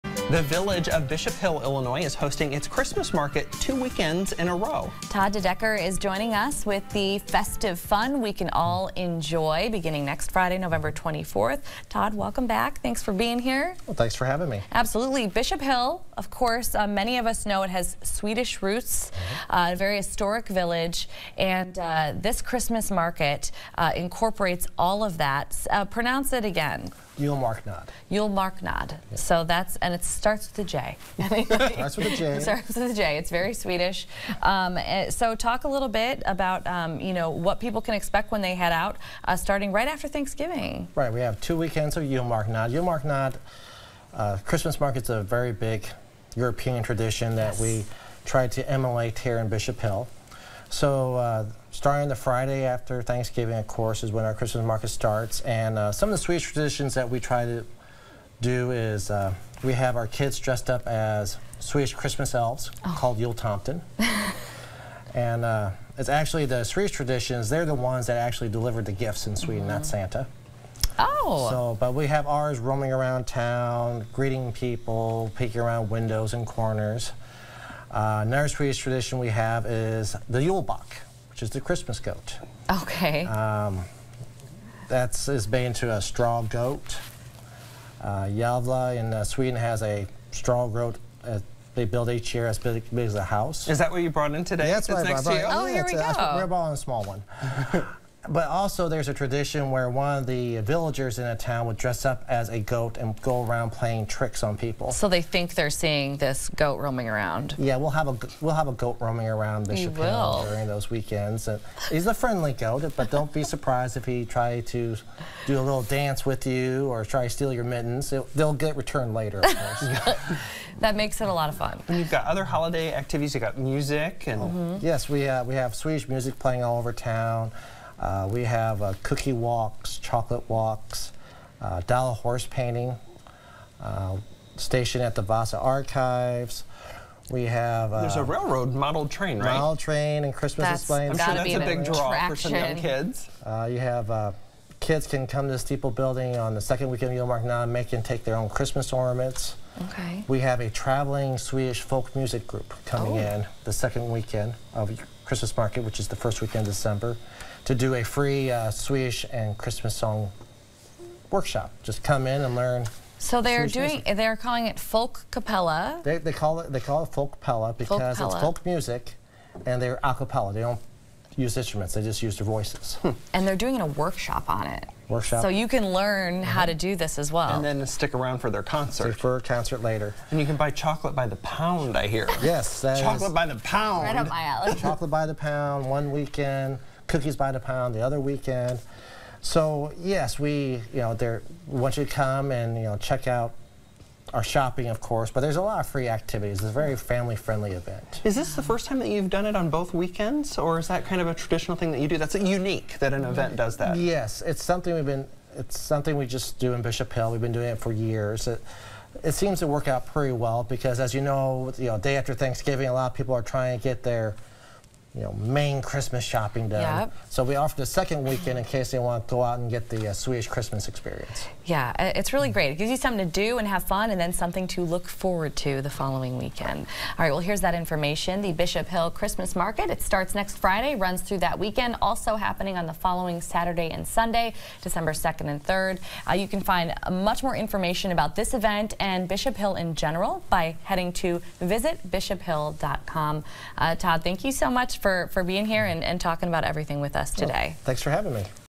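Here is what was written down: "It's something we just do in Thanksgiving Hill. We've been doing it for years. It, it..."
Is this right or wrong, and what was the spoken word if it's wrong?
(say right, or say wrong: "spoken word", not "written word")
wrong: "Bishop", not "Thanksgiving".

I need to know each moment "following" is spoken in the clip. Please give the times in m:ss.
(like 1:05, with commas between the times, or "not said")
3:45, 3:52.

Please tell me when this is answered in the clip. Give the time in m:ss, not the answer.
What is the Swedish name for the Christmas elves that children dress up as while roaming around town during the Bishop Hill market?
1:03.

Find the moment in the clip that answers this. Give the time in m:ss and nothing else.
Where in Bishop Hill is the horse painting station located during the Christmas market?
2:15.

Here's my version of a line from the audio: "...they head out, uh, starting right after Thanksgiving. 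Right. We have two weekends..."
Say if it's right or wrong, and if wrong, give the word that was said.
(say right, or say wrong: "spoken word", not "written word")
right.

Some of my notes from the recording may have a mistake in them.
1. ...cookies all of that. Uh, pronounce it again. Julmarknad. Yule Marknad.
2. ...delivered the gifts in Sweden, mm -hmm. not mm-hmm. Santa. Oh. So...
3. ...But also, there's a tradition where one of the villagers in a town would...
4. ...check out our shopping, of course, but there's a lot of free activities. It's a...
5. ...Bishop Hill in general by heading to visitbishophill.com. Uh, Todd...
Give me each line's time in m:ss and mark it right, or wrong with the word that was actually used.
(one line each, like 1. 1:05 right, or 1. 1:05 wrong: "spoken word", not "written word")
1. 0:23 wrong: "incorporates", not "cookies"
2. 1:08 right
3. 1:38 right
4. 3:13 right
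5. 3:59 right.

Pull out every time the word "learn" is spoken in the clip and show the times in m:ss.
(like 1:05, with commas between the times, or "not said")
2:42, 2:55.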